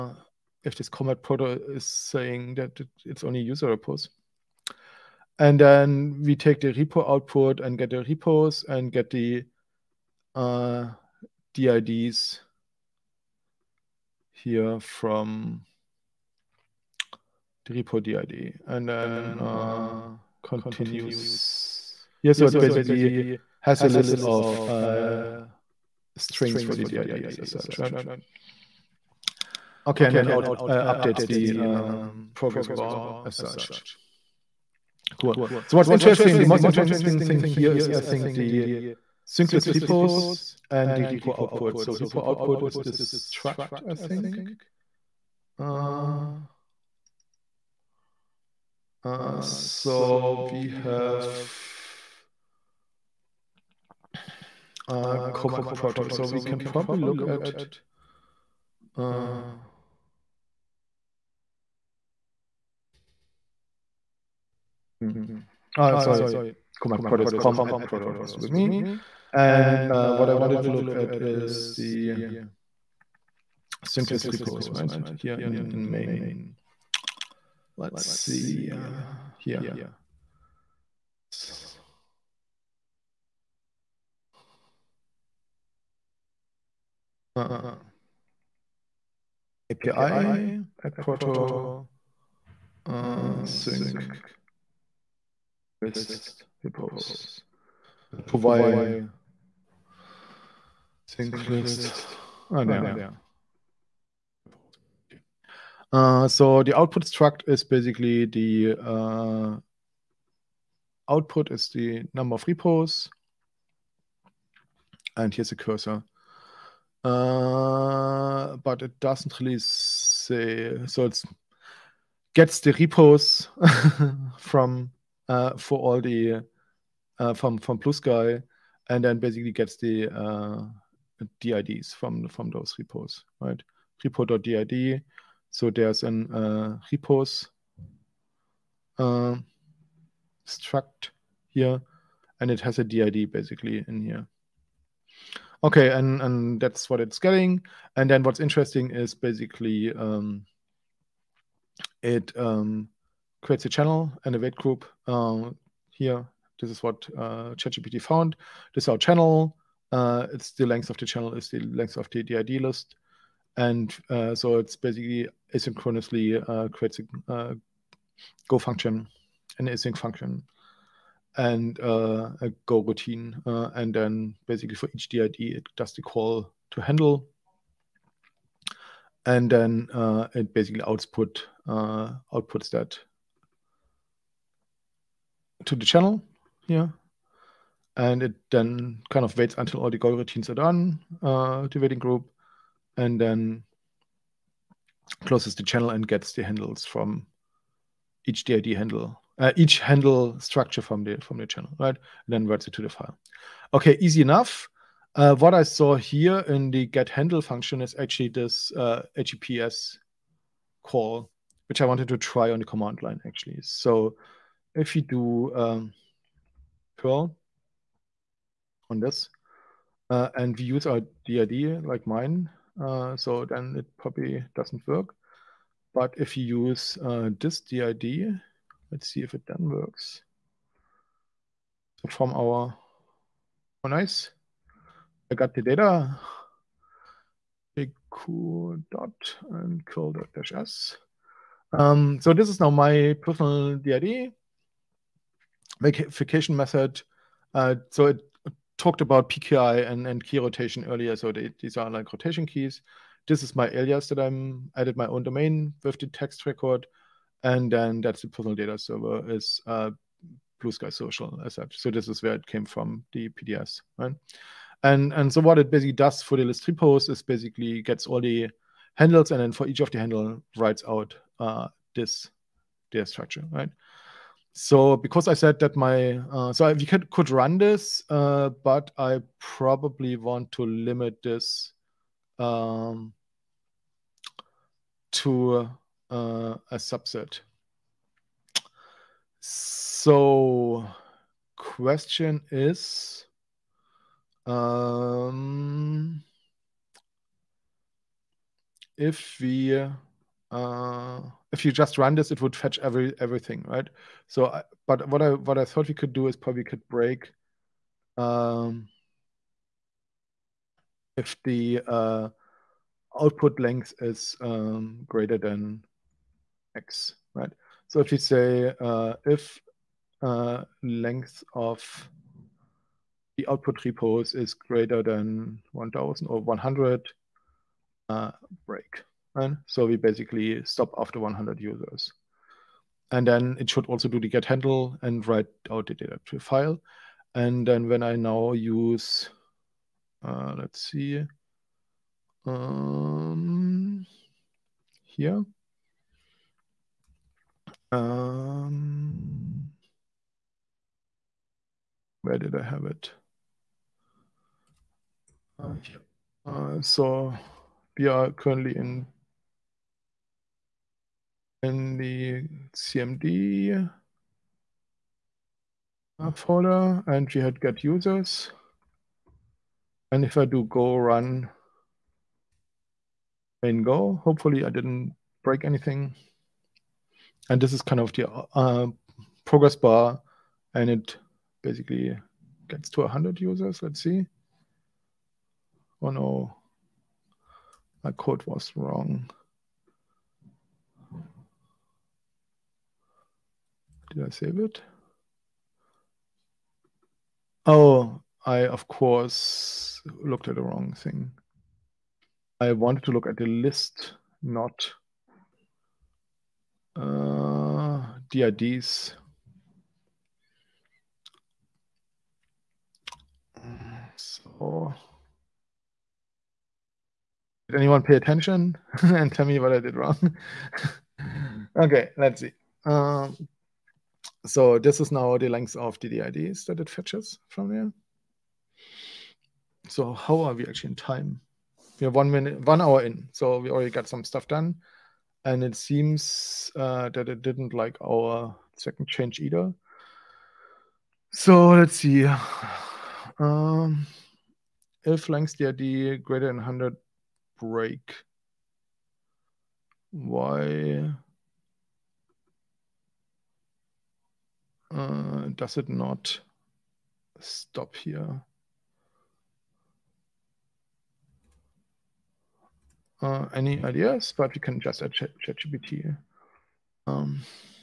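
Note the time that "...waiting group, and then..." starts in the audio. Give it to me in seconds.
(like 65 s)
191 s.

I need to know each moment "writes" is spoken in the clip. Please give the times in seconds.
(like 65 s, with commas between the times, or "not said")
202 s, 270 s, 335 s.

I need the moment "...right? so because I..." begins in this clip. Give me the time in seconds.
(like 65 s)
273 s.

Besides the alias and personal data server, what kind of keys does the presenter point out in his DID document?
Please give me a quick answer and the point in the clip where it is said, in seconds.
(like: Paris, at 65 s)
rotation keys, at 252 s.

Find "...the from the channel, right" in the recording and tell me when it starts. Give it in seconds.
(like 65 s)
201 s.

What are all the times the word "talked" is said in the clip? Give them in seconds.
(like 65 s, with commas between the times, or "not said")
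248 s.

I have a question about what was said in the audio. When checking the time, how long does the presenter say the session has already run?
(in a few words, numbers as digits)
one hour.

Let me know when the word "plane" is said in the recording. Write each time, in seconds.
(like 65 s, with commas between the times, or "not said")
not said.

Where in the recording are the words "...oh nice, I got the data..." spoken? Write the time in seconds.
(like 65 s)
233 s.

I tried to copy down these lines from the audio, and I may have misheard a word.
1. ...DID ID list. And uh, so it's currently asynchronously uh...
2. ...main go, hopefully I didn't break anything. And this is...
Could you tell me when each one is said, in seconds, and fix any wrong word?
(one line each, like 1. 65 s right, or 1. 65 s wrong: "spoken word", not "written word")
1. 162 s wrong: "basically", not "currently"
2. 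373 s right.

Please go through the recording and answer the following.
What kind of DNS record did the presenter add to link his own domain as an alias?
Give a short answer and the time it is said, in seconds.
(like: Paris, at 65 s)
text record, at 256 s.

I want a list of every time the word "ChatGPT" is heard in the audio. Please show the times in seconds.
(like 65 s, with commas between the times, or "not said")
157 s, 465 s.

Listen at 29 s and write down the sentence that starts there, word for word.
Okay, and then out, uh, updates the um, progress bar as such.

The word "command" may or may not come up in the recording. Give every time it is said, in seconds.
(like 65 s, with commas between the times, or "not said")
66 s, 212 s.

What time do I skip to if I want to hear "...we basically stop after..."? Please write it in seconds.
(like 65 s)
329 s.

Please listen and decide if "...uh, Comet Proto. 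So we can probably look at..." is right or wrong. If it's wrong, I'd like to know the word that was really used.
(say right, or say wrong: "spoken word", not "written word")
right.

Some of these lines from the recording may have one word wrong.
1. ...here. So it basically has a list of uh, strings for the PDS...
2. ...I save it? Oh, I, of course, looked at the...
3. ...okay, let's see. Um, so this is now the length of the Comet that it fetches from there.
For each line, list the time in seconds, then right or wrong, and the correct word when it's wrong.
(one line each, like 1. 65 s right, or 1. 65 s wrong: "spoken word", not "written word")
1. 22 s wrong: "DIDs", not "PDS"
2. 394 s right
3. 421 s wrong: "DIDs", not "Comet".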